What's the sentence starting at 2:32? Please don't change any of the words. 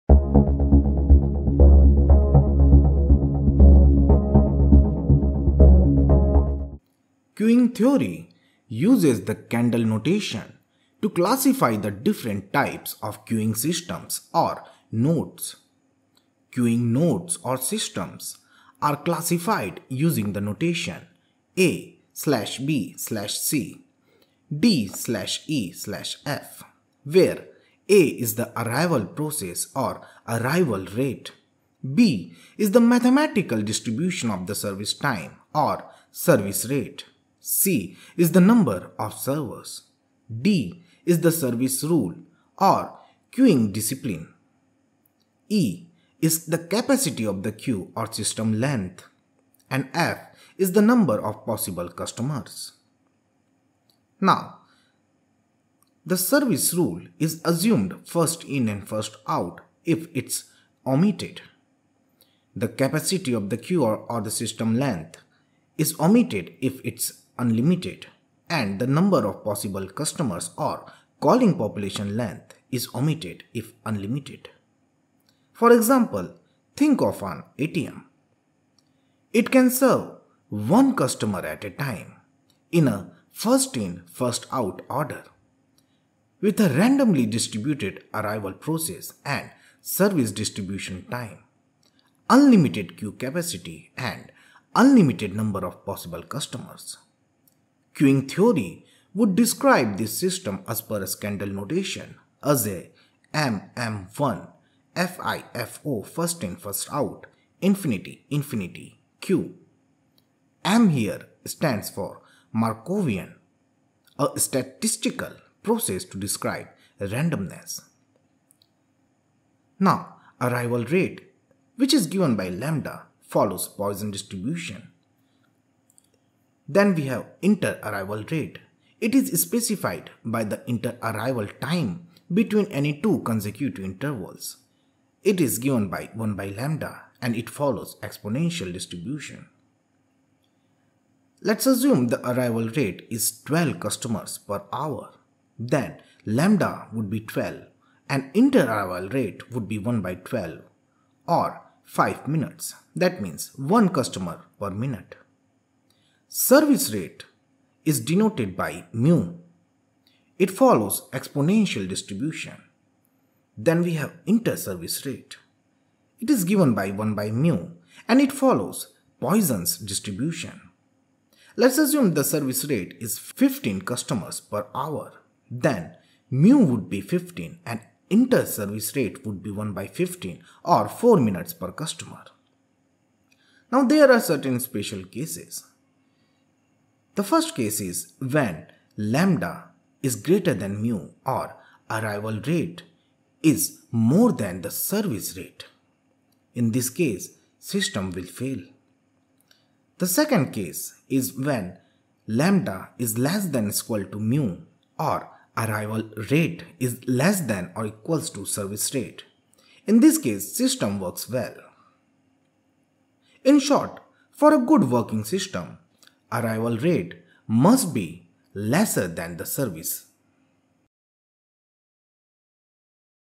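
That means 1 customer per minute.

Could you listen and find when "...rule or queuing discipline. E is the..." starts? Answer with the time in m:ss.
0:41.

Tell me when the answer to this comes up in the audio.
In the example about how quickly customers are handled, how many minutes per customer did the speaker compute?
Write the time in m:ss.
3:00.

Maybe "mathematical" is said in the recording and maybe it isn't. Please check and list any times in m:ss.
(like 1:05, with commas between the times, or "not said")
0:32.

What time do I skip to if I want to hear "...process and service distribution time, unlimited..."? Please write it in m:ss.
1:28.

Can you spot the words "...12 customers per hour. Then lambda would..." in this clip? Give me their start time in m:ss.
2:23.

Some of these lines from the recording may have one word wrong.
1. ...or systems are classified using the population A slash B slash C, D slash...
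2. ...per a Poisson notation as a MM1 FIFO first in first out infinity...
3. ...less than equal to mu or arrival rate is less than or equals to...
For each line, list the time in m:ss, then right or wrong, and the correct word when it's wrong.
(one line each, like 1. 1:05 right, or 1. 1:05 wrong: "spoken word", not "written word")
1. 0:17 wrong: "notation", not "population"
2. 1:40 wrong: "Kendall", not "Poisson"
3. 3:23 right.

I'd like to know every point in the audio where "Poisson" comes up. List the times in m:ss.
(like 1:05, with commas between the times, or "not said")
2:03, 2:49.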